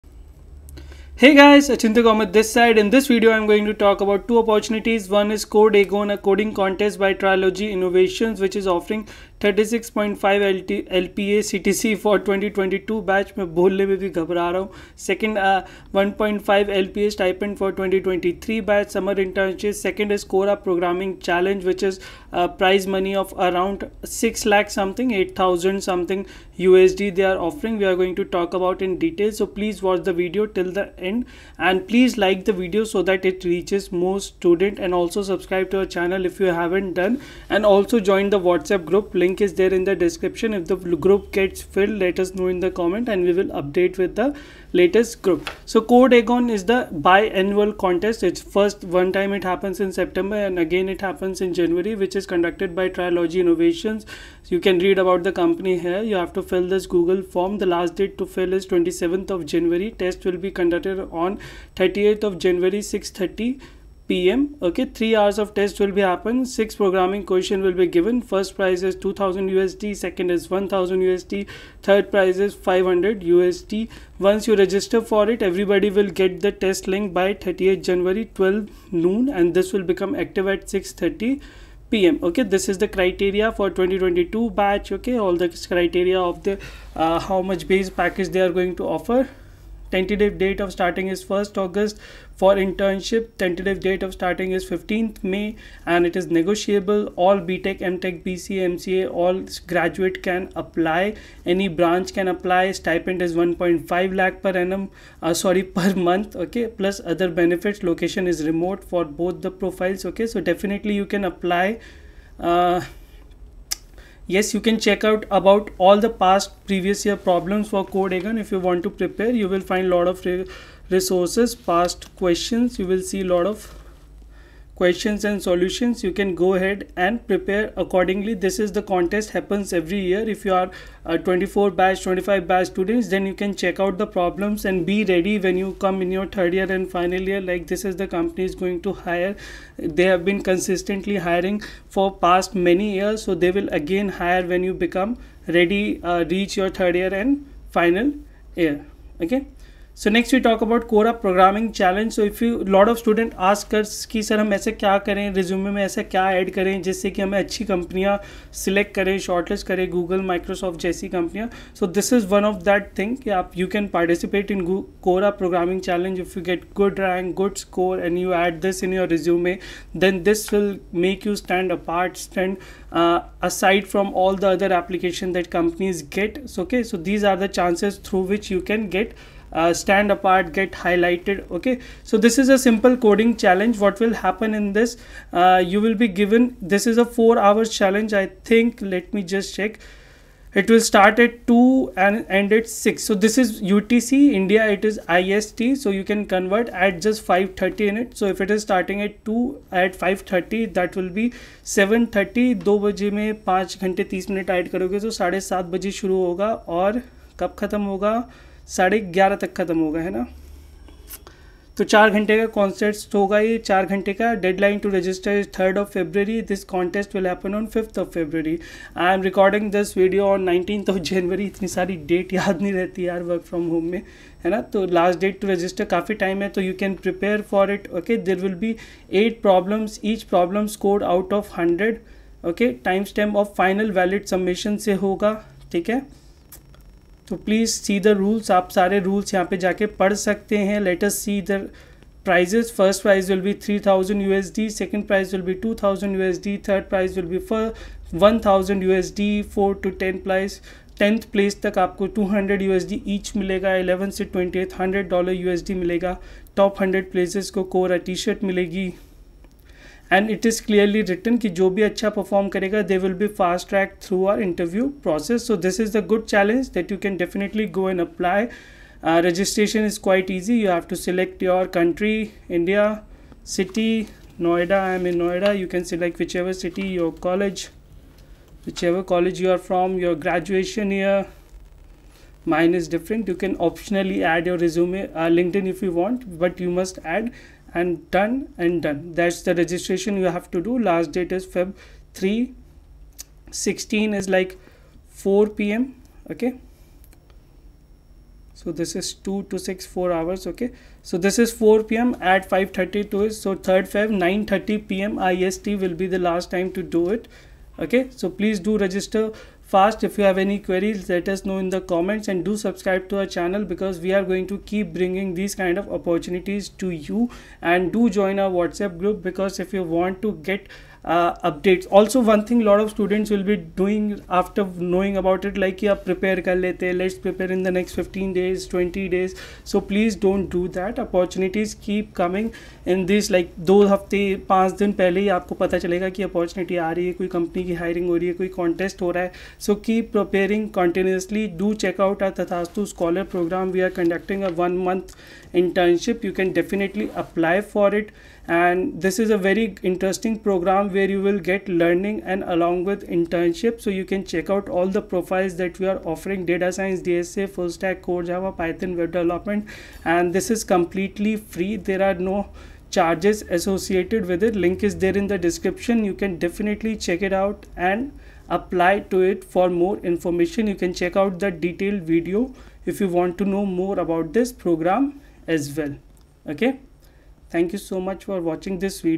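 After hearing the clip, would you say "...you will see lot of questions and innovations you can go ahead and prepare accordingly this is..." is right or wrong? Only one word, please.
wrong.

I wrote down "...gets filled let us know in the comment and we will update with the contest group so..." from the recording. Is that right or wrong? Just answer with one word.
wrong.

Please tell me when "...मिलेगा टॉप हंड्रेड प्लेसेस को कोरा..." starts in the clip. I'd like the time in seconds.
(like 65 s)
255 s.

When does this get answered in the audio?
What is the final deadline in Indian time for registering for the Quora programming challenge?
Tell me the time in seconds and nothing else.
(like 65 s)
303 s.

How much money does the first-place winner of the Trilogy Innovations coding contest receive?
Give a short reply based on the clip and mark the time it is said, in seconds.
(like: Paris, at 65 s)
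2000 USD, at 69 s.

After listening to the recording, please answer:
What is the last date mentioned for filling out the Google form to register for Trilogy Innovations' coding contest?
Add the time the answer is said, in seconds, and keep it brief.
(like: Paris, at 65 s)
27th of January, at 58 s.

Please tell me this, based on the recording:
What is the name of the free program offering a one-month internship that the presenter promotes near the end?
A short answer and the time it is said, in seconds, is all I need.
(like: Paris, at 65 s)
Tathastu Scholar, at 342 s.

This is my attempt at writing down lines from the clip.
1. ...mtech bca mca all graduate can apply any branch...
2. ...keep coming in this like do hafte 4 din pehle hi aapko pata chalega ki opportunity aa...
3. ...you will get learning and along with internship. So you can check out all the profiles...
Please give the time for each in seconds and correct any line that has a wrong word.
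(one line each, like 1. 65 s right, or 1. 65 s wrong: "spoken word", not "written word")
1. 97 s right
2. 331 s wrong: "5", not "4"
3. 351 s right.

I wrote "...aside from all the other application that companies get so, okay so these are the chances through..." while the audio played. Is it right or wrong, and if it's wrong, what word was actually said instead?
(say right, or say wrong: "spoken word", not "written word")
right.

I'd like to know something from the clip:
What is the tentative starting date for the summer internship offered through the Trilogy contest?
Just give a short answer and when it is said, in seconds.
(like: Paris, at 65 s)
15th May, at 94 s.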